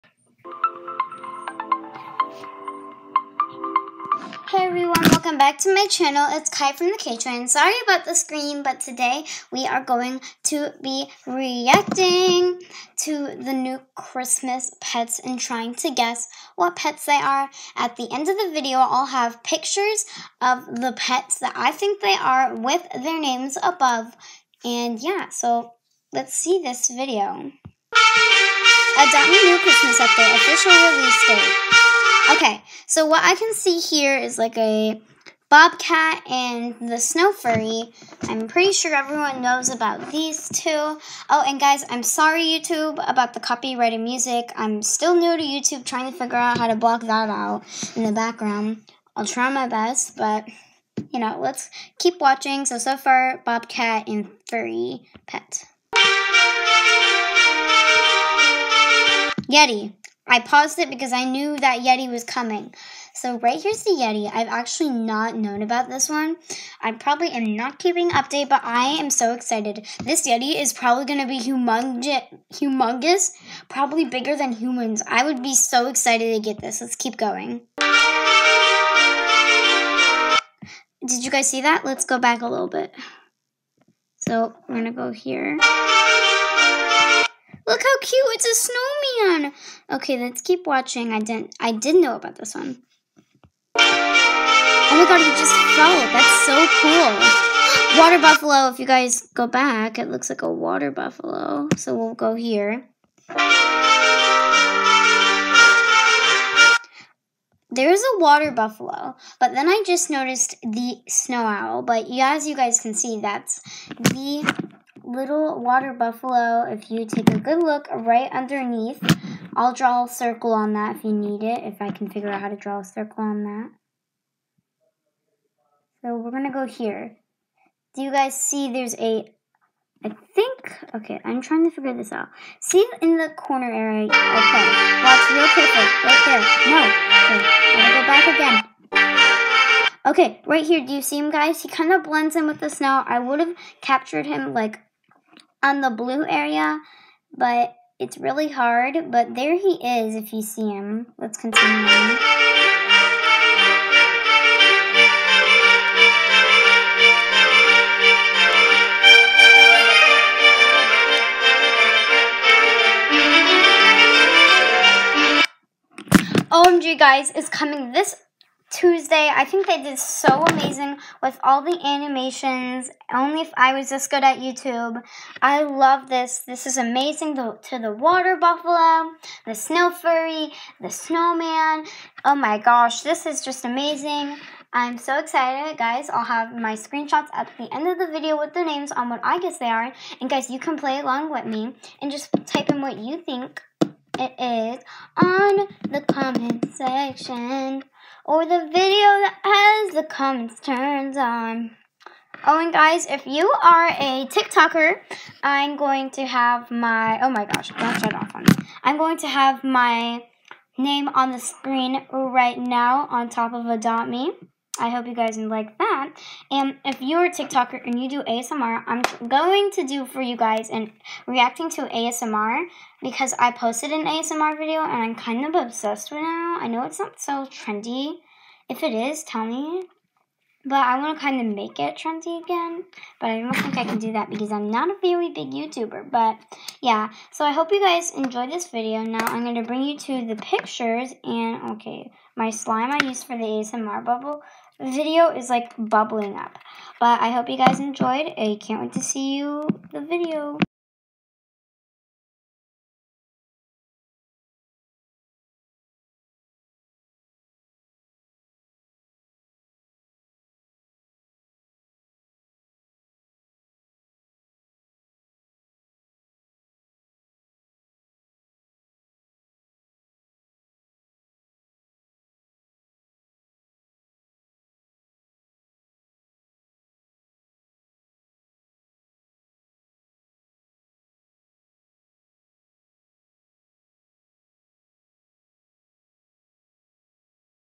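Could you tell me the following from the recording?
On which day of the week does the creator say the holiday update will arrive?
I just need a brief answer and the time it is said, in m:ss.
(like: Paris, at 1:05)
Tuesday, at 2:48.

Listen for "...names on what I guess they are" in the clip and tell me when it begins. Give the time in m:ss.
3:08.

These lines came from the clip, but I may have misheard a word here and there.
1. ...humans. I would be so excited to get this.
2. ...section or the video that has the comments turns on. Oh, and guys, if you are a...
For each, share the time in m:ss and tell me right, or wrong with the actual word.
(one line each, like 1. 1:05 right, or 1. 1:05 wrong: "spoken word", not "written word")
1. 1:14 right
2. 3:16 right.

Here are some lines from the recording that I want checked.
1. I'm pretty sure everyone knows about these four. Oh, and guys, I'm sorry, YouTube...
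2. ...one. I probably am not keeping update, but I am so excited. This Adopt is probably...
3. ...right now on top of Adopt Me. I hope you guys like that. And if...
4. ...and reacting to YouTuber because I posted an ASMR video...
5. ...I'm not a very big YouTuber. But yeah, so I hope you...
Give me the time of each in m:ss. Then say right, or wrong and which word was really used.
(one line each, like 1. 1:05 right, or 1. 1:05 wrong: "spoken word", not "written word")
1. 0:38 wrong: "two", not "four"
2. 1:06 wrong: "Yeti", not "Adopt"
3. 3:32 right
4. 3:40 wrong: "ASMR", not "YouTuber"
5. 3:54 right.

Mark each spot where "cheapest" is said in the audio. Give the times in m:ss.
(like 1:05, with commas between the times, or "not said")
not said.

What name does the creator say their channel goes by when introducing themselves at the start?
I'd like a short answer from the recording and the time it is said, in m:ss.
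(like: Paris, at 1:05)
The K-Train, at 0:06.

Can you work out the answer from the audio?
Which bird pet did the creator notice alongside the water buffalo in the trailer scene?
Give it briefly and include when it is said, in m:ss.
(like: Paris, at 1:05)
Snow owl, at 1:51.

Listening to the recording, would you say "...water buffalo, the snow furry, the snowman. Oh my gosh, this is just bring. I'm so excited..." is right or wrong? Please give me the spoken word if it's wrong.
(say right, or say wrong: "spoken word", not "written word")
wrong: "amazing", not "bring".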